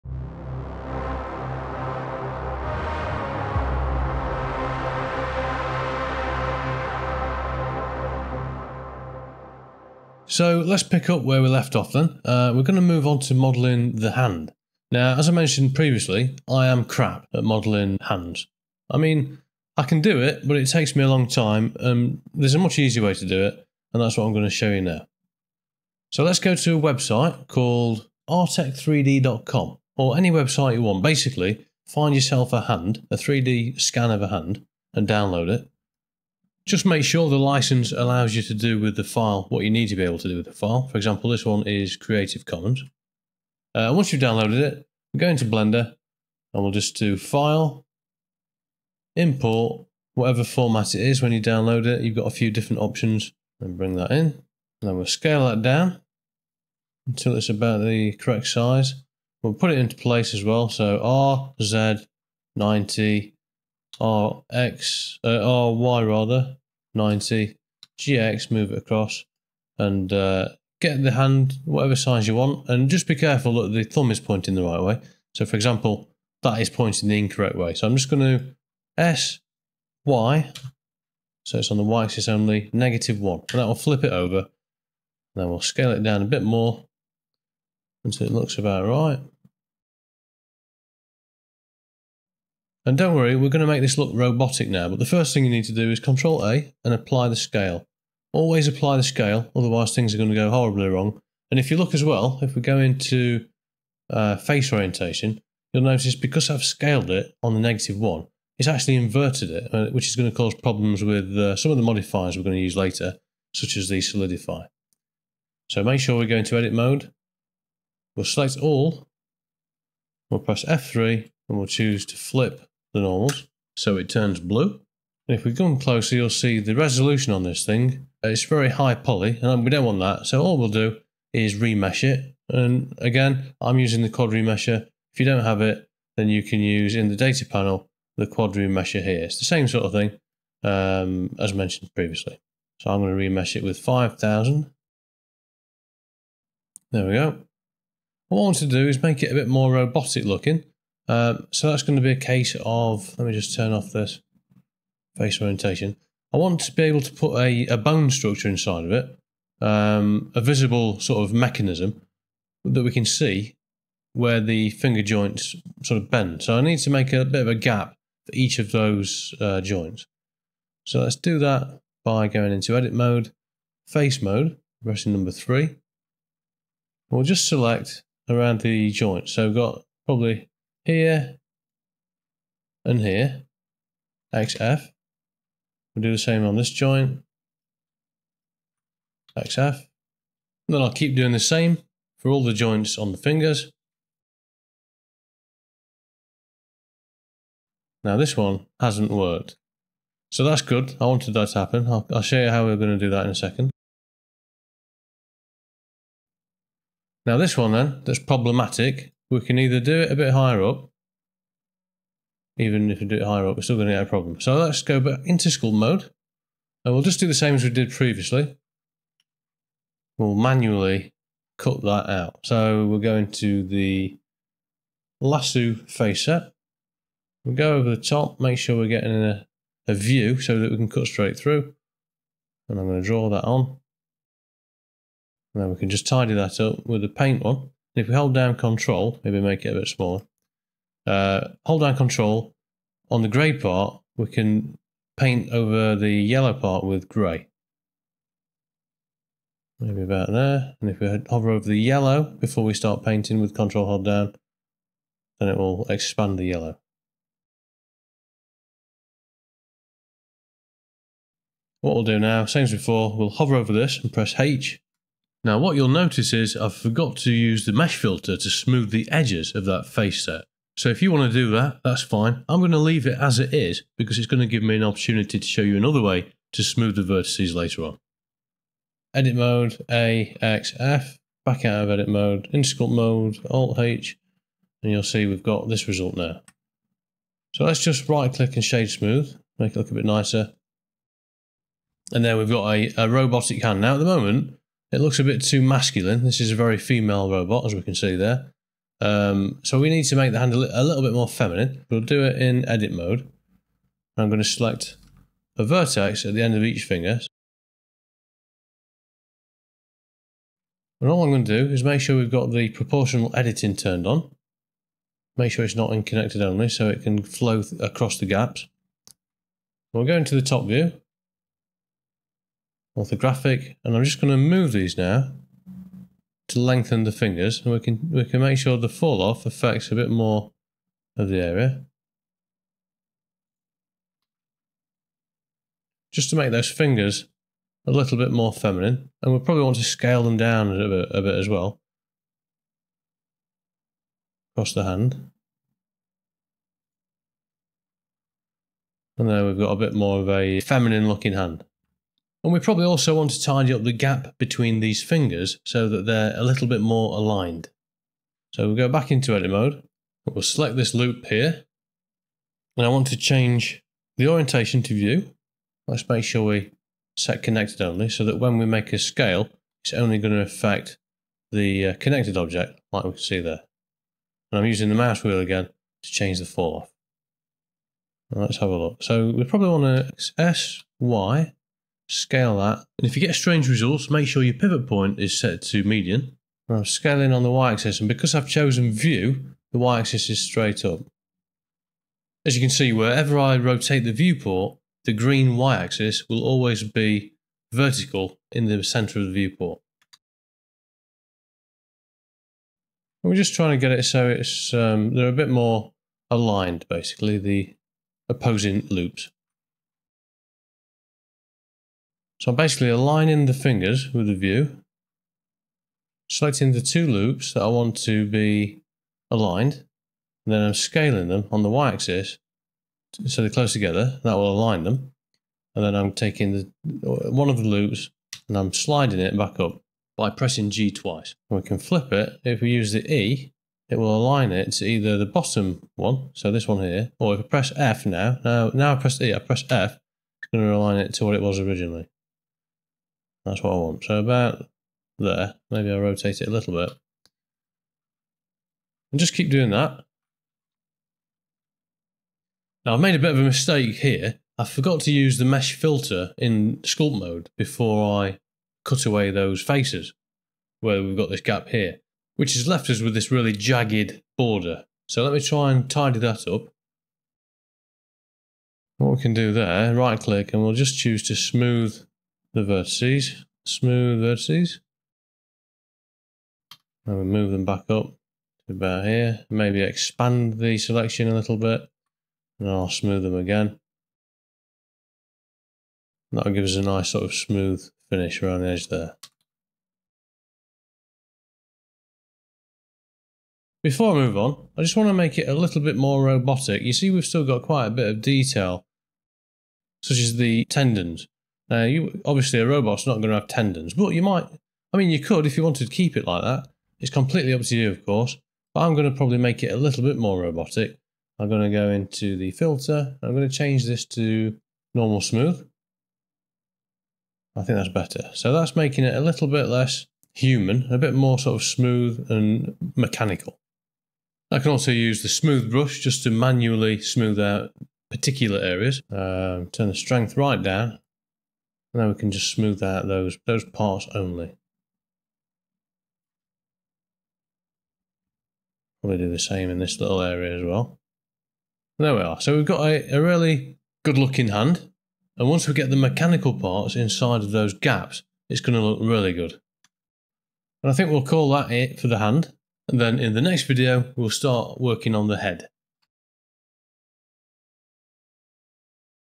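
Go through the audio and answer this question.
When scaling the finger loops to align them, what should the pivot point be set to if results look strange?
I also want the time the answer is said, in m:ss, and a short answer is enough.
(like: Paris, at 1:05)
Median, at 6:25.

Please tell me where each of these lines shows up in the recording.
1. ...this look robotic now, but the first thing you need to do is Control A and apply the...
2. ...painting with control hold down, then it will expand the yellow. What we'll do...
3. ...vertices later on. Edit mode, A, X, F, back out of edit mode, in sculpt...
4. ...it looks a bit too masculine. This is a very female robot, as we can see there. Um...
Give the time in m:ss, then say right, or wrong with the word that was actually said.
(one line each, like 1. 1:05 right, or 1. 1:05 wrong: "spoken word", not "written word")
1. 1:33 right
2. 4:13 right
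3. 4:37 right
4. 4:54 right.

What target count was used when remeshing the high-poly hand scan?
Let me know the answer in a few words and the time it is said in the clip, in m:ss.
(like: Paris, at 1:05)
5000, at 2:23.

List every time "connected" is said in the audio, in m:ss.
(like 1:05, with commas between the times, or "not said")
5:16, 6:07, 6:11.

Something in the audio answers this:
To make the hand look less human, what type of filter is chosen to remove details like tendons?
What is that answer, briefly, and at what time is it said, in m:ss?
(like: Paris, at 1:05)
Normal smooth, at 8:34.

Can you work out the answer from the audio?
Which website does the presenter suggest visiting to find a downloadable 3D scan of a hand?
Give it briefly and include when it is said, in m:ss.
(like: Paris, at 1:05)
artec3d.com, at 0:28.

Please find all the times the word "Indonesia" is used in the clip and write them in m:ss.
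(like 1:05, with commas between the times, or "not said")
not said.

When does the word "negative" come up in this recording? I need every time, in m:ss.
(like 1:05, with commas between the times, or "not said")
1:22, 1:47.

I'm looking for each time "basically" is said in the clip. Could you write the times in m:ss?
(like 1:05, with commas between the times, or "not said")
0:31, 6:46, 6:52.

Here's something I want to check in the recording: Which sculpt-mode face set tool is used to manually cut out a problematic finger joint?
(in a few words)
Lasso face set.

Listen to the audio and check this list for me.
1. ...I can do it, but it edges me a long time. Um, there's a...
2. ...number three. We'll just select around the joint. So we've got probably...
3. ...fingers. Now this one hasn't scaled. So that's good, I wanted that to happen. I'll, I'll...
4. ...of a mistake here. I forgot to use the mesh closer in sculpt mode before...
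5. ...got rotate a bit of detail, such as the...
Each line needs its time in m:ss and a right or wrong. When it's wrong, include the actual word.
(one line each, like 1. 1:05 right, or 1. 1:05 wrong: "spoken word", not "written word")
1. 0:19 wrong: "takes", not "edges"
2. 2:55 right
3. 3:13 wrong: "worked", not "scaled"
4. 7:33 wrong: "filter", not "closer"
5. 8:17 wrong: "quite", not "rotate".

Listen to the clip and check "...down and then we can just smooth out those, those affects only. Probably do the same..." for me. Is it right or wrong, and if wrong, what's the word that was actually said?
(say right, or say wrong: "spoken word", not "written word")
wrong: "parts", not "affects".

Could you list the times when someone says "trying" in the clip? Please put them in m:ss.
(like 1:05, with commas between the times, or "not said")
6:43.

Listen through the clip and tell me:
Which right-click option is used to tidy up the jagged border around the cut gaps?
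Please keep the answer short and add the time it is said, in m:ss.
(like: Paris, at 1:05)
Smooth vertices, at 7:53.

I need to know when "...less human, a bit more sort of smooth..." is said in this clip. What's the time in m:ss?
8:39.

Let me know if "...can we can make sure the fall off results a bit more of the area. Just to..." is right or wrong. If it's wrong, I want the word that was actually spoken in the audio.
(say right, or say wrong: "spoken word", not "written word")
wrong: "affects", not "results".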